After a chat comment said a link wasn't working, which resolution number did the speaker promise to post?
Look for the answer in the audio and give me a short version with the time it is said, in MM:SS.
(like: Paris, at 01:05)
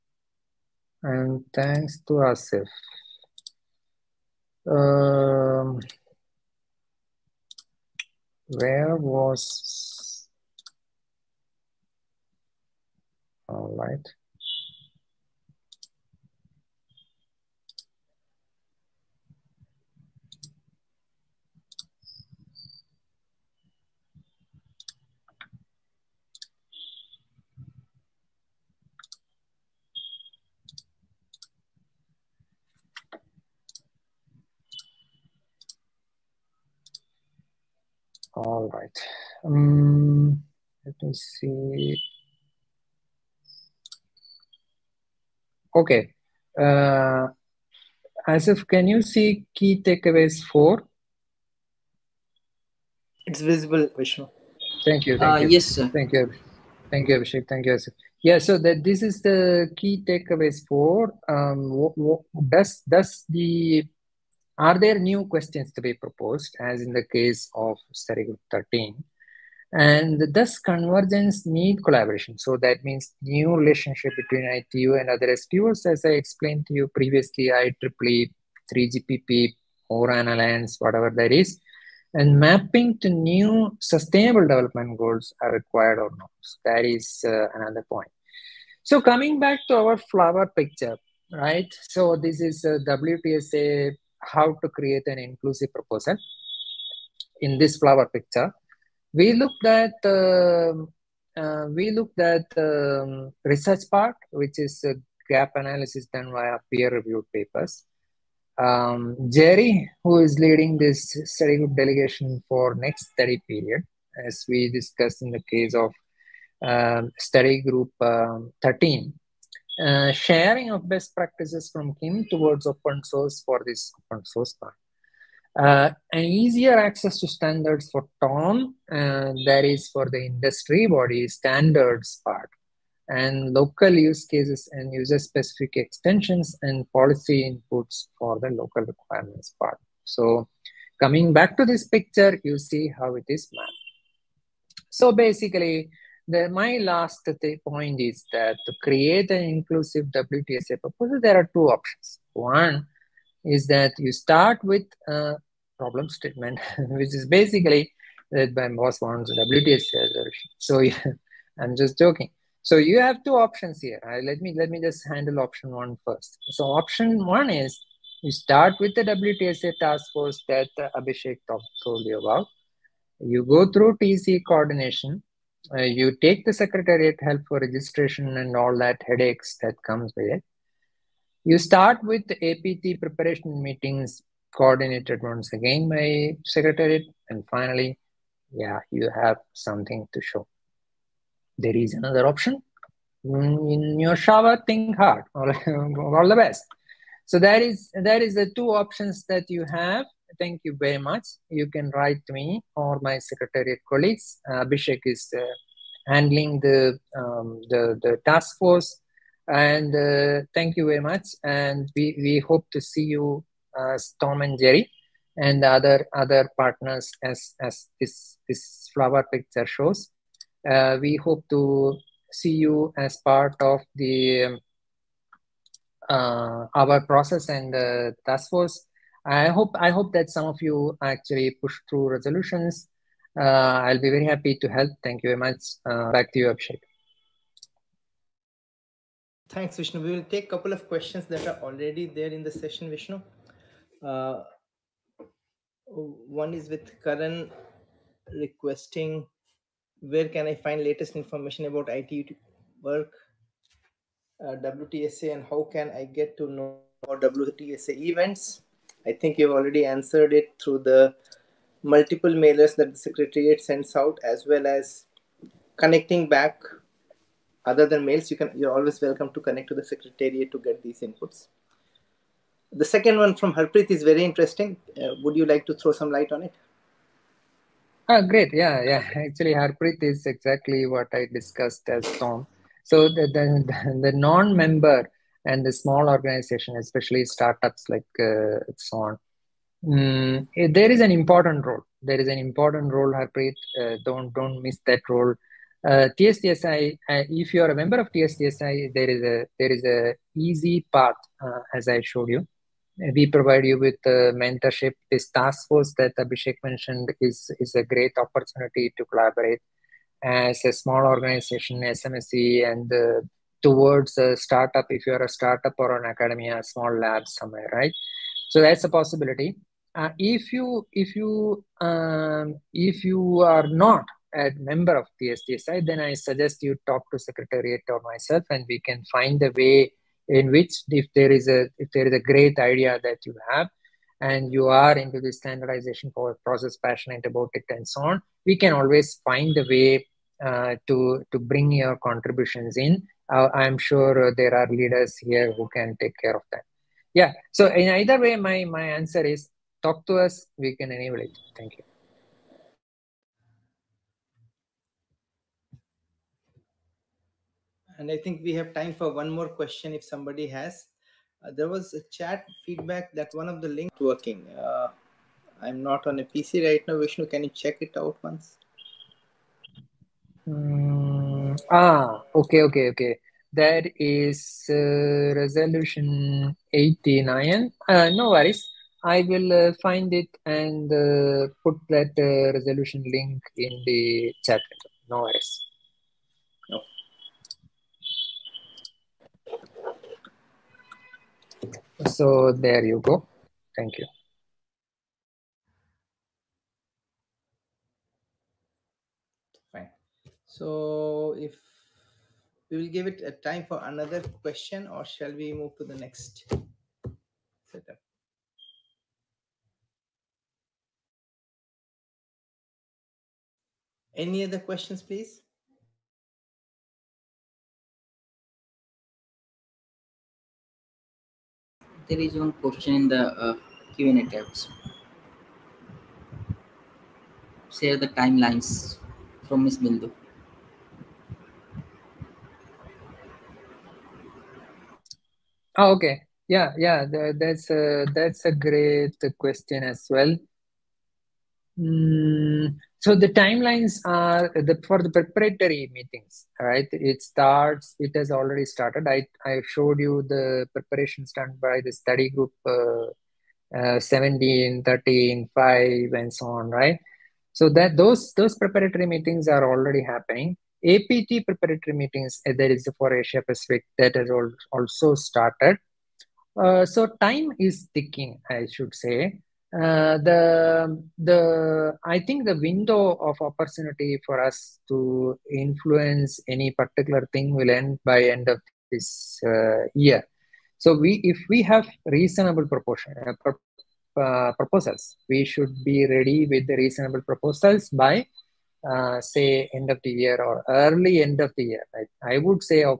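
89, at 06:16.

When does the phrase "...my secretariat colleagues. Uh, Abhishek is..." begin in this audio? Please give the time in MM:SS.
03:23.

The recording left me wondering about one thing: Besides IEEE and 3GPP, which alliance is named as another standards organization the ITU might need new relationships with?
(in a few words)
ORAN Alliance.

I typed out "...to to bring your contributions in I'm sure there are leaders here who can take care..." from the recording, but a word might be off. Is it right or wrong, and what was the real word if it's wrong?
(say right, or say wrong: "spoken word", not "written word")
right.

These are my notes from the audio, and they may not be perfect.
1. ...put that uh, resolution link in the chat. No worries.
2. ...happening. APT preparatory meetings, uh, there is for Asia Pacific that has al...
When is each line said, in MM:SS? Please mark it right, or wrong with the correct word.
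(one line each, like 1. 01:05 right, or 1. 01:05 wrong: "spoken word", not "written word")
1. 06:21 right
2. 07:40 right.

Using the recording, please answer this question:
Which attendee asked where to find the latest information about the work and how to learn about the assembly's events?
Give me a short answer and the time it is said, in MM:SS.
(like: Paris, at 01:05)
Karan, at 04:07.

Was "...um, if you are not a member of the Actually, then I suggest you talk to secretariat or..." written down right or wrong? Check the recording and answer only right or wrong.
wrong.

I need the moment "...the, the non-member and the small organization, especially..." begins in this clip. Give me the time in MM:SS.
04:43.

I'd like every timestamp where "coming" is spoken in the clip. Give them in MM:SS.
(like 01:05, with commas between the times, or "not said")
01:29, 02:21.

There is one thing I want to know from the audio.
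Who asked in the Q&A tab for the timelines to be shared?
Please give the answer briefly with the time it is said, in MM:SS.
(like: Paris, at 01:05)
Bindu, at 07:09.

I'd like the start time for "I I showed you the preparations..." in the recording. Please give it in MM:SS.
07:29.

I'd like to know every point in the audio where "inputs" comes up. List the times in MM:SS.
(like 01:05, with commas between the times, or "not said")
02:17, 04:31.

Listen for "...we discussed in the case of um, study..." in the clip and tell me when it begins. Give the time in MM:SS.
01:54.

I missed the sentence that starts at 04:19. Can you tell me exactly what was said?
I think you've already answered it through the multiple mailers that the Secretariat sends out, as well as connecting back.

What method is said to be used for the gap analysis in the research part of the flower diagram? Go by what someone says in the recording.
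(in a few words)
peer-reviewed papers.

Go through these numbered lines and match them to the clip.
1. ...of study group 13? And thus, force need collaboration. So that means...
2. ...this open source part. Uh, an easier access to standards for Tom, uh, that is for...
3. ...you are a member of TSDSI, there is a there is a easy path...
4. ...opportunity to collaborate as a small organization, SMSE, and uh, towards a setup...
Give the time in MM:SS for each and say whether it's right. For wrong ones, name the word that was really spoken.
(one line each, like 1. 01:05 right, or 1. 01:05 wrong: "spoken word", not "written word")
1. 01:07 wrong: "convergence", not "force"
2. 02:03 right
3. 04:57 right
4. 05:08 wrong: "startup", not "setup".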